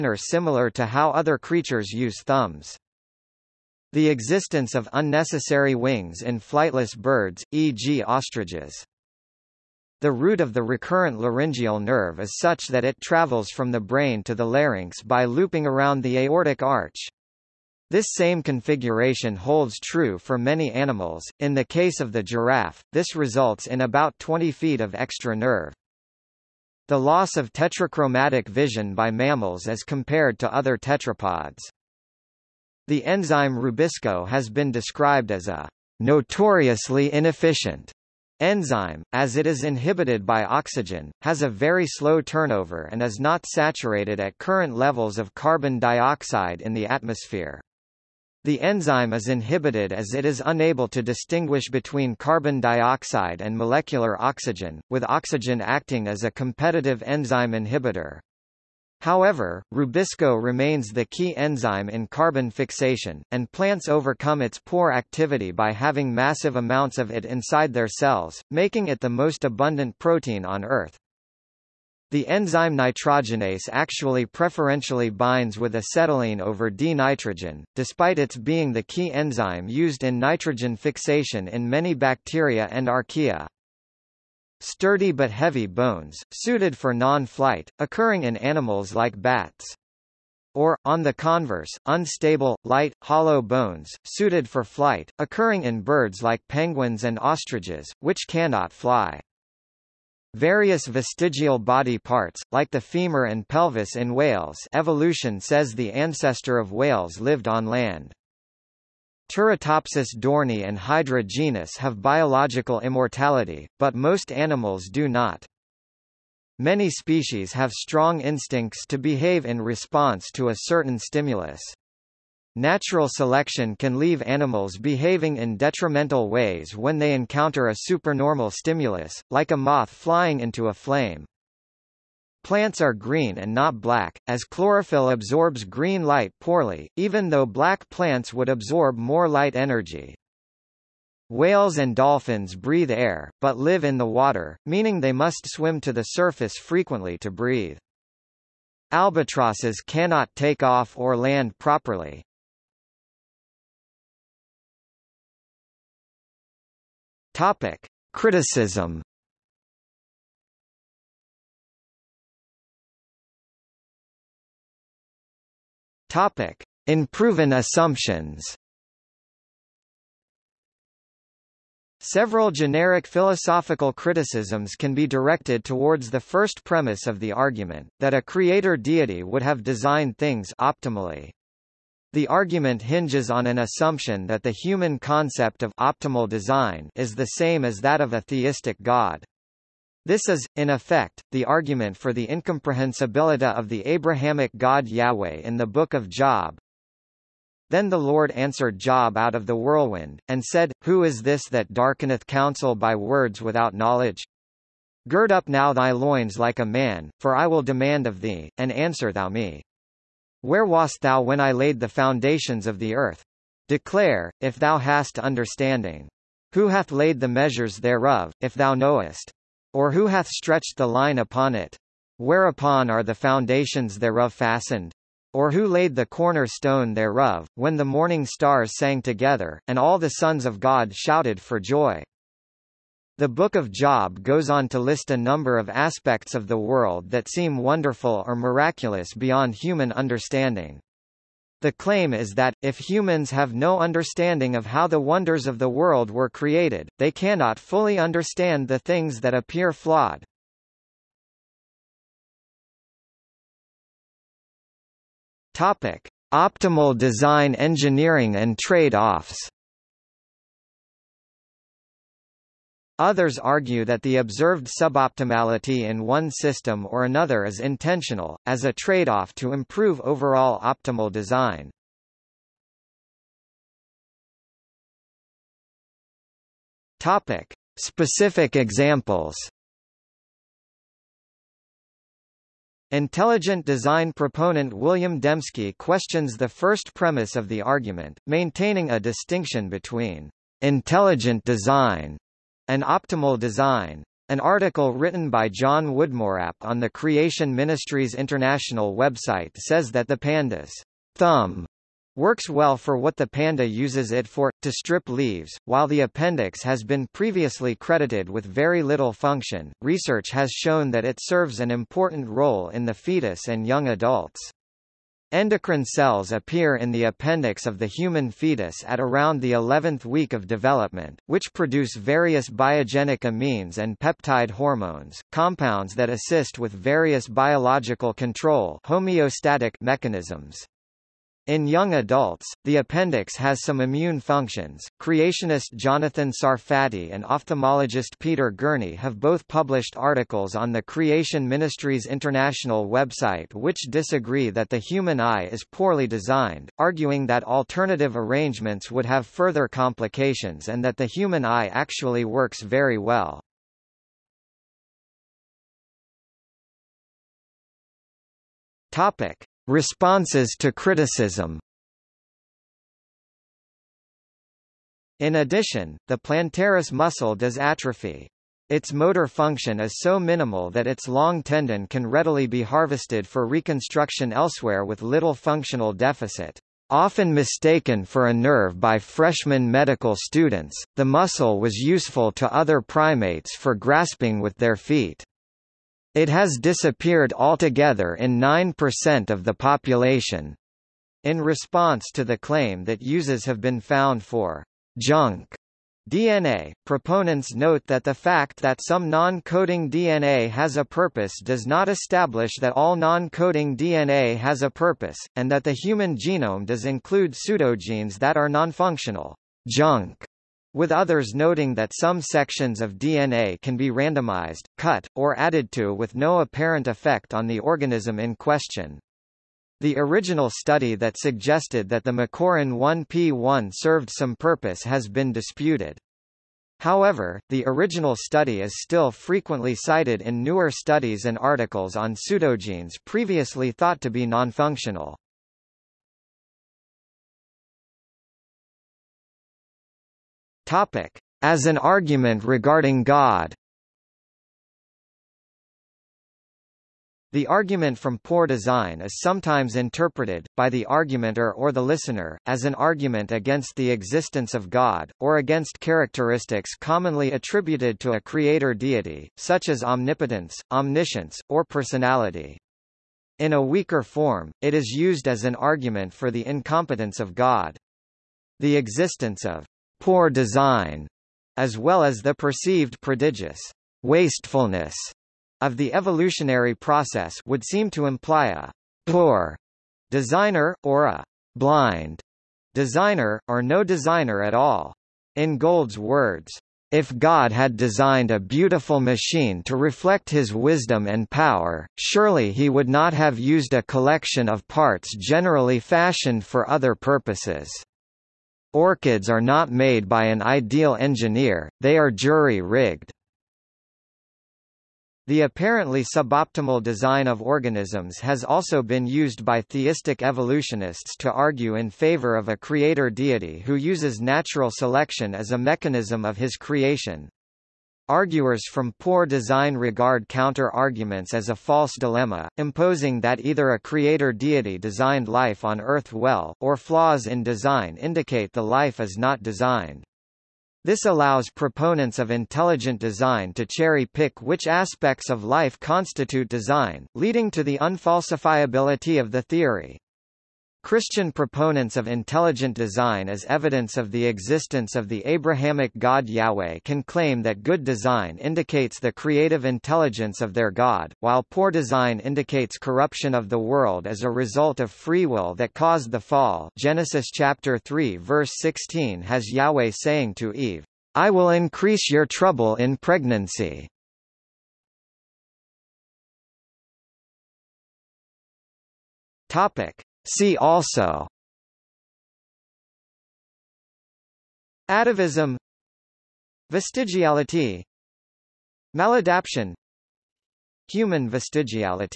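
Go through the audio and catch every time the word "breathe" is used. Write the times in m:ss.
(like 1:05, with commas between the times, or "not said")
2:22, 2:27.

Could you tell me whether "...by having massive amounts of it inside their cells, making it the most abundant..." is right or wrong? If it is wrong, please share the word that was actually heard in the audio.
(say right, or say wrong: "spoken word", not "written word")
right.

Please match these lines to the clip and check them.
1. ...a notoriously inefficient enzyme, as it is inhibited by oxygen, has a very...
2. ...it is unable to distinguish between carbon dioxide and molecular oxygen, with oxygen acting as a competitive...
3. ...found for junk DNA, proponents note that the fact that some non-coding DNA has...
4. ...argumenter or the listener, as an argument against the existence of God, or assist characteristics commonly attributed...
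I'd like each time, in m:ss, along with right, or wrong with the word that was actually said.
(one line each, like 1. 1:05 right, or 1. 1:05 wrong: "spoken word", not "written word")
1. 0:35 right
2. 0:50 right
3. 6:33 right
4. 7:30 wrong: "against", not "assist".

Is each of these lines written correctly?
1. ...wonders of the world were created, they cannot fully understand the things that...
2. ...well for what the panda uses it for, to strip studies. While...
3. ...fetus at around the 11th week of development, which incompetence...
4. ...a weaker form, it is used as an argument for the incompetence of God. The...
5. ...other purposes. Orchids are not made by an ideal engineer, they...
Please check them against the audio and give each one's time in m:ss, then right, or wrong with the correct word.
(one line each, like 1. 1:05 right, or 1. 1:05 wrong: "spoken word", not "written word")
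1. 4:05 right
2. 5:02 wrong: "leaves", not "studies"
3. 5:18 wrong: "produce", not "incompetence"
4. 7:43 right
5. 8:16 right.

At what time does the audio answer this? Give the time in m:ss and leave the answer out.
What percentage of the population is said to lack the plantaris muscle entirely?
6:28.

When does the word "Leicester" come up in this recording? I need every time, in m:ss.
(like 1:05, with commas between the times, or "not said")
not said.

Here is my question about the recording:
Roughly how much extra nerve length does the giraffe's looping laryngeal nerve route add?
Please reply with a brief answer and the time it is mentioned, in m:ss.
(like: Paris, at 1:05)
20 feet, at 0:24.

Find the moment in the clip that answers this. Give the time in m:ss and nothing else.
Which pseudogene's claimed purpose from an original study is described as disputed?
7:02.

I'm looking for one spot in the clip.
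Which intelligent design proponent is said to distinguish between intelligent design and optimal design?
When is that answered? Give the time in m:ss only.
4:44.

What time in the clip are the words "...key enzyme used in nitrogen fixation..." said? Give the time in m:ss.
1:18.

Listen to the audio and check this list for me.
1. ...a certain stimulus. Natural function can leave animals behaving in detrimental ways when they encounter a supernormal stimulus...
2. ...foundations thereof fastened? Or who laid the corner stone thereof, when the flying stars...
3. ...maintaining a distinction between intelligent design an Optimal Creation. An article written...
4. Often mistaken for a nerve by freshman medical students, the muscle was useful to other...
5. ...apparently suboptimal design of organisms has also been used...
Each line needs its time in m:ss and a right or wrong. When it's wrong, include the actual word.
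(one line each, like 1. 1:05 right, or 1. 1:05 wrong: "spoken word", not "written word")
1. 2:00 wrong: "selection", not "function"
2. 3:43 wrong: "morning", not "flying"
3. 4:48 wrong: "Design", not "Creation"
4. 6:16 right
5. 8:25 right.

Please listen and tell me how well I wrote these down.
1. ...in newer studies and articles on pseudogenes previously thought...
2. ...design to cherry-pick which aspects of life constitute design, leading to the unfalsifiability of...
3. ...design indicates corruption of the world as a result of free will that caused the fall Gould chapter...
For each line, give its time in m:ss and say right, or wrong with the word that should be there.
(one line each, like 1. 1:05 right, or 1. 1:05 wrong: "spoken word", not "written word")
1. 7:10 right
2. 8:52 right
3. 9:11 wrong: "Genesis", not "Gould".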